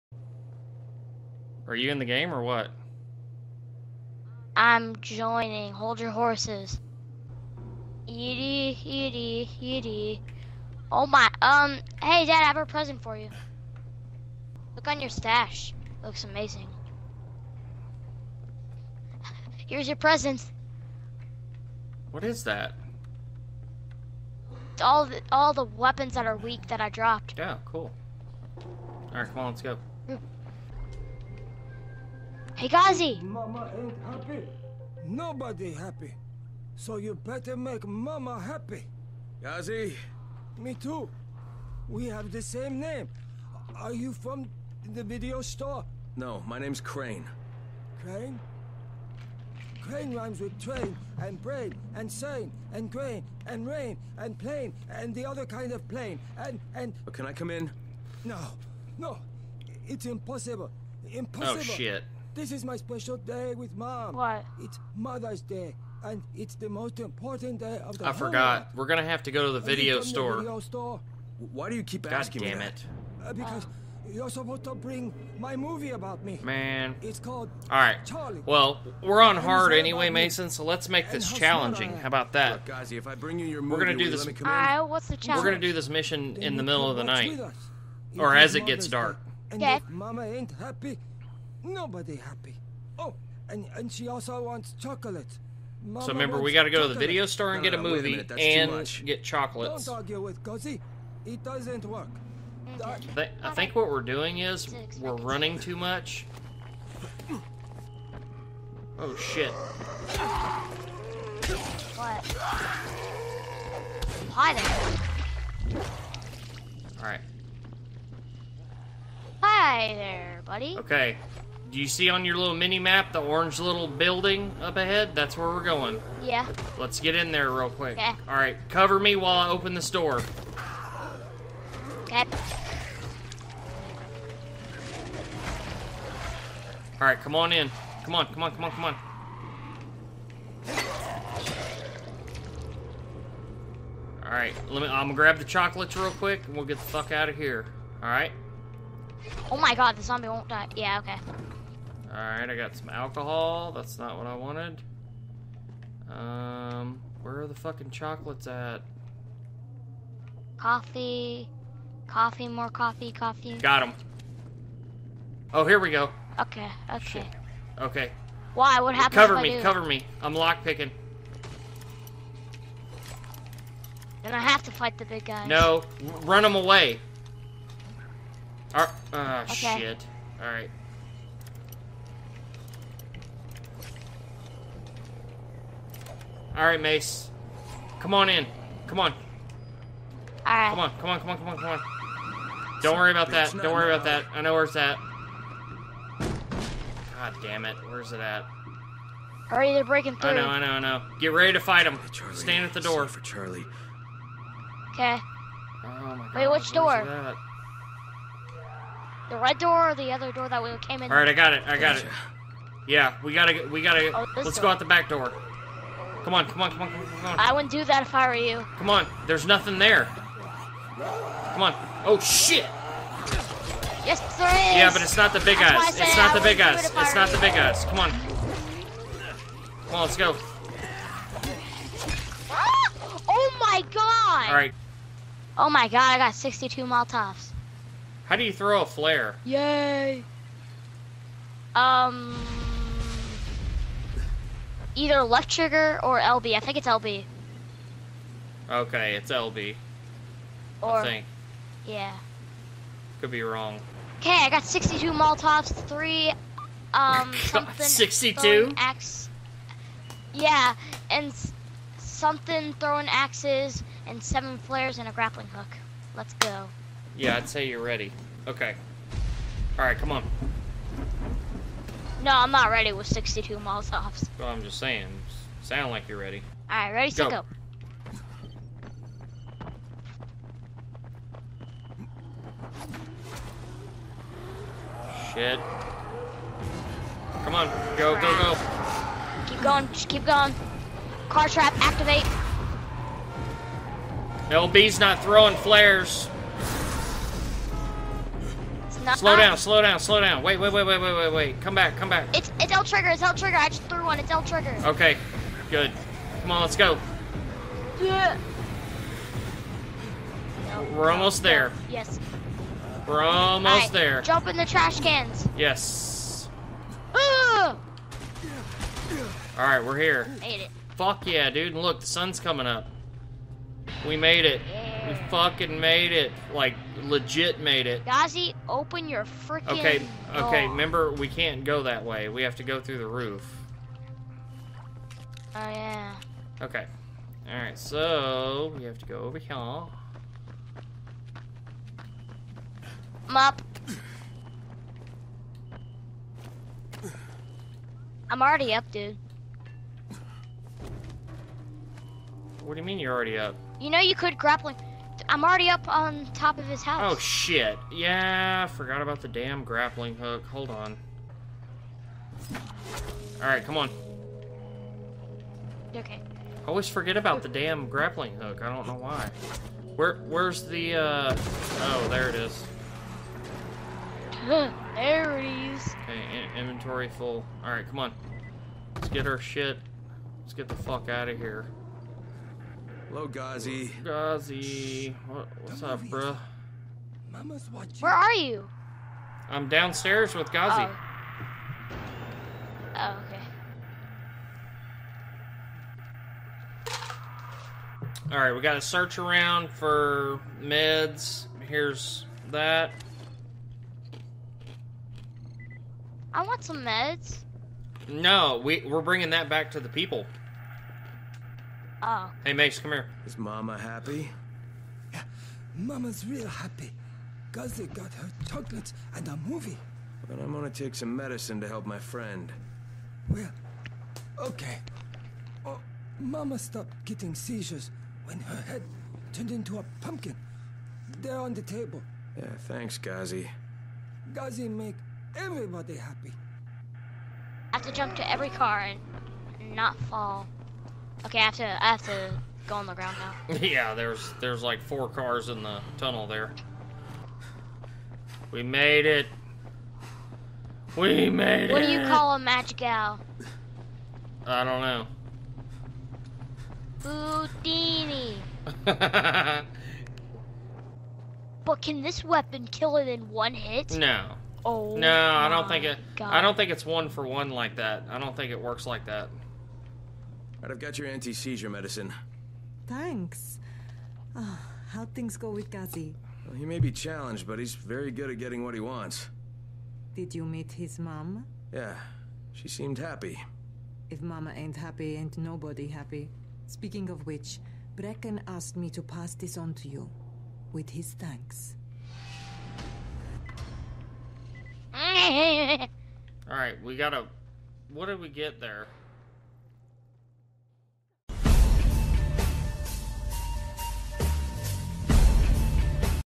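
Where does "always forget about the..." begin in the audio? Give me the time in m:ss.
6:06.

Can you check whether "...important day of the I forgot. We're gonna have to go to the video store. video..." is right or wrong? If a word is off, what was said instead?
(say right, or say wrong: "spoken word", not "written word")
right.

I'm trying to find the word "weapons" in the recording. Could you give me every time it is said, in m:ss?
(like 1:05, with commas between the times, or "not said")
0:25, 7:42.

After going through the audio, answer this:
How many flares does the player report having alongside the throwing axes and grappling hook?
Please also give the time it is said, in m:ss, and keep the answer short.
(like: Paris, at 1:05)
7, at 4:24.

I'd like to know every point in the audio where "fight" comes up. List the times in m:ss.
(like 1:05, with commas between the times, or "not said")
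2:54, 3:21.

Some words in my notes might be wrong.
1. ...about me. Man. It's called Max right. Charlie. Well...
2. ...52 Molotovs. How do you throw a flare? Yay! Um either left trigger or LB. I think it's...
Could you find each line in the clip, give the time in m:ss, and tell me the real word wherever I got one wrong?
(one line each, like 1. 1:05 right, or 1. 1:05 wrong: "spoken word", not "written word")
1. 1:15 wrong: "All", not "Max"
2. 3:56 wrong: "62", not "52".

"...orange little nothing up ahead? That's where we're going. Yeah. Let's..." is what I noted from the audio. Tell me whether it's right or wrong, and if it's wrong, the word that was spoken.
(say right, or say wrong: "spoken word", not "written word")
wrong: "building", not "nothing".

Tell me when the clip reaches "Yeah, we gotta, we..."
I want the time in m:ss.
3:32.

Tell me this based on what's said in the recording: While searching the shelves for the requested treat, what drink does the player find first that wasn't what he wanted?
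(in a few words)
Alcohol.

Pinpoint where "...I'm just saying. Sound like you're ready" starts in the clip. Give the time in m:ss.
4:34.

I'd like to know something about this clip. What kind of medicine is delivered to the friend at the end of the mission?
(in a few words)
Anti-seizure medicine.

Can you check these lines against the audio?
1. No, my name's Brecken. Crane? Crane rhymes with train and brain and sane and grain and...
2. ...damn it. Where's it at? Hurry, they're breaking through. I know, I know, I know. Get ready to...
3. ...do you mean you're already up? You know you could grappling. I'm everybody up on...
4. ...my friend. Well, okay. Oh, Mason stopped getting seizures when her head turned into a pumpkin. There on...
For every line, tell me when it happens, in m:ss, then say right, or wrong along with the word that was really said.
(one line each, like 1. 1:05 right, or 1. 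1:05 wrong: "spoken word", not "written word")
1. 0:46 wrong: "Crane", not "Brecken"
2. 3:17 right
3. 5:52 wrong: "already", not "everybody"
4. 7:01 wrong: "Mama", not "Mason".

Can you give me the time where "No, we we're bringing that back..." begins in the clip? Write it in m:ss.
6:48.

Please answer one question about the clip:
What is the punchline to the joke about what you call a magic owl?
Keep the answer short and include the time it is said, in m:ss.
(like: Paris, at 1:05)
Houdini, at 7:37.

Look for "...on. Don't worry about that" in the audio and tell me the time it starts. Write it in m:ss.
3:11.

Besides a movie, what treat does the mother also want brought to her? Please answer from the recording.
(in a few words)
Chocolate.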